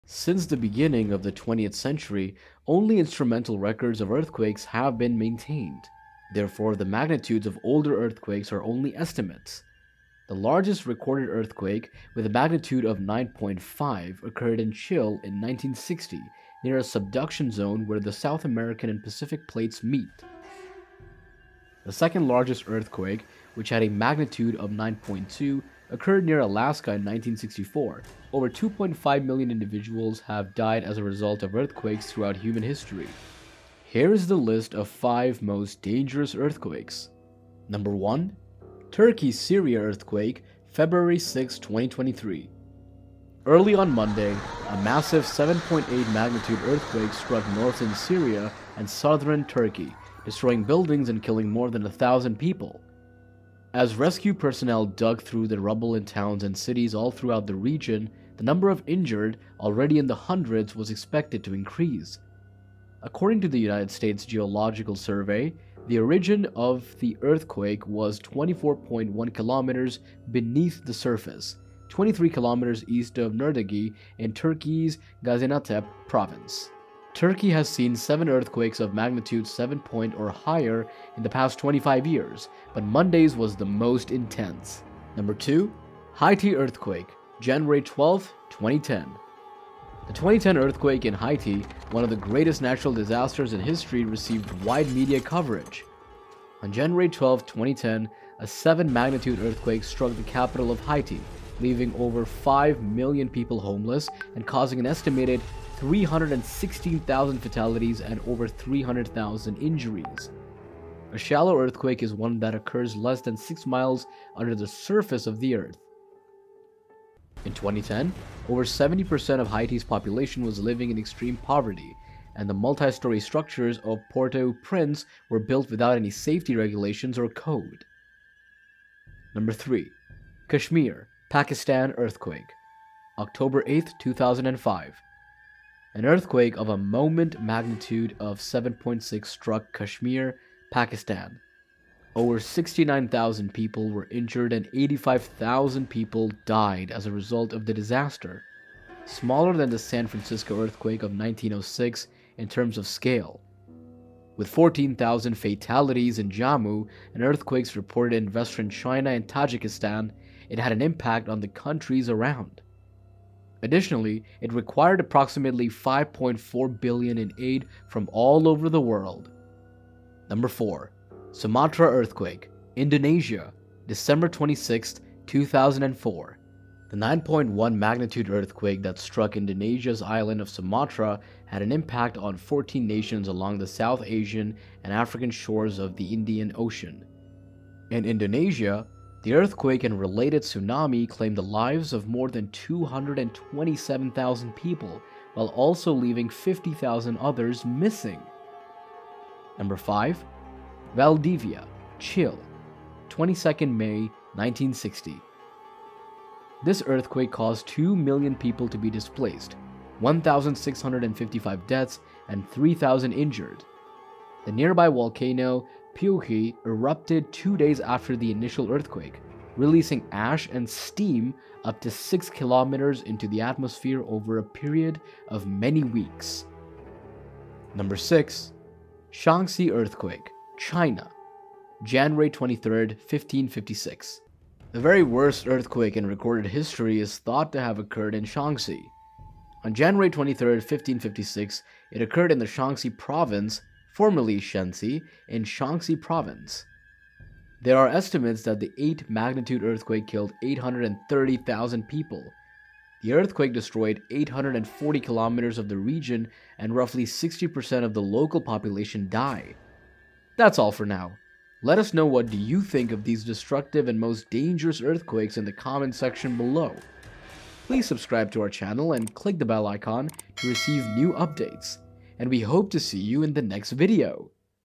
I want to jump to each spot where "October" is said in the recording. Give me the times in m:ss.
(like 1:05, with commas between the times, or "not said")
2:13.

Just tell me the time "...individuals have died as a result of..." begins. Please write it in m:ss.
0:29.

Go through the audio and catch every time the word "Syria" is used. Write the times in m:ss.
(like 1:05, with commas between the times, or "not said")
0:39, 0:47.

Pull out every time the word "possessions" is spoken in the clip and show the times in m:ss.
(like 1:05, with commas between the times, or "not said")
not said.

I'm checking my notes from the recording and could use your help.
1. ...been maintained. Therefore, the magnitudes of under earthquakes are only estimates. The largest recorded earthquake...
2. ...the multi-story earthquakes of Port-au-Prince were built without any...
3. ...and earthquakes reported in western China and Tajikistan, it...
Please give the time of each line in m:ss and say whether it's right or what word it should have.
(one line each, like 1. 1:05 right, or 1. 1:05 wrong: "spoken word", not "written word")
1. 0:04 wrong: "older", not "under"
2. 2:02 wrong: "structures", not "earthquakes"
3. 2:37 right.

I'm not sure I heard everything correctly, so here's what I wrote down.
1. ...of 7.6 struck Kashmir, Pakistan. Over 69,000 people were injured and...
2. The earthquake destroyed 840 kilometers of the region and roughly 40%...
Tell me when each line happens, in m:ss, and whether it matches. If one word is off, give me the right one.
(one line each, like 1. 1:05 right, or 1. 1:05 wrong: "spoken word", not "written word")
1. 2:18 right
2. 4:13 wrong: "60", not "40".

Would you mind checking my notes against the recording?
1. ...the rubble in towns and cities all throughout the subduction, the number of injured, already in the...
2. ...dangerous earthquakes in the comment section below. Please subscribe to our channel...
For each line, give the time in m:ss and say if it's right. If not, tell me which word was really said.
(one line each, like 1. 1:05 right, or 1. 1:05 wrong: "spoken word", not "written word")
1. 0:55 wrong: "region", not "subduction"
2. 4:24 right.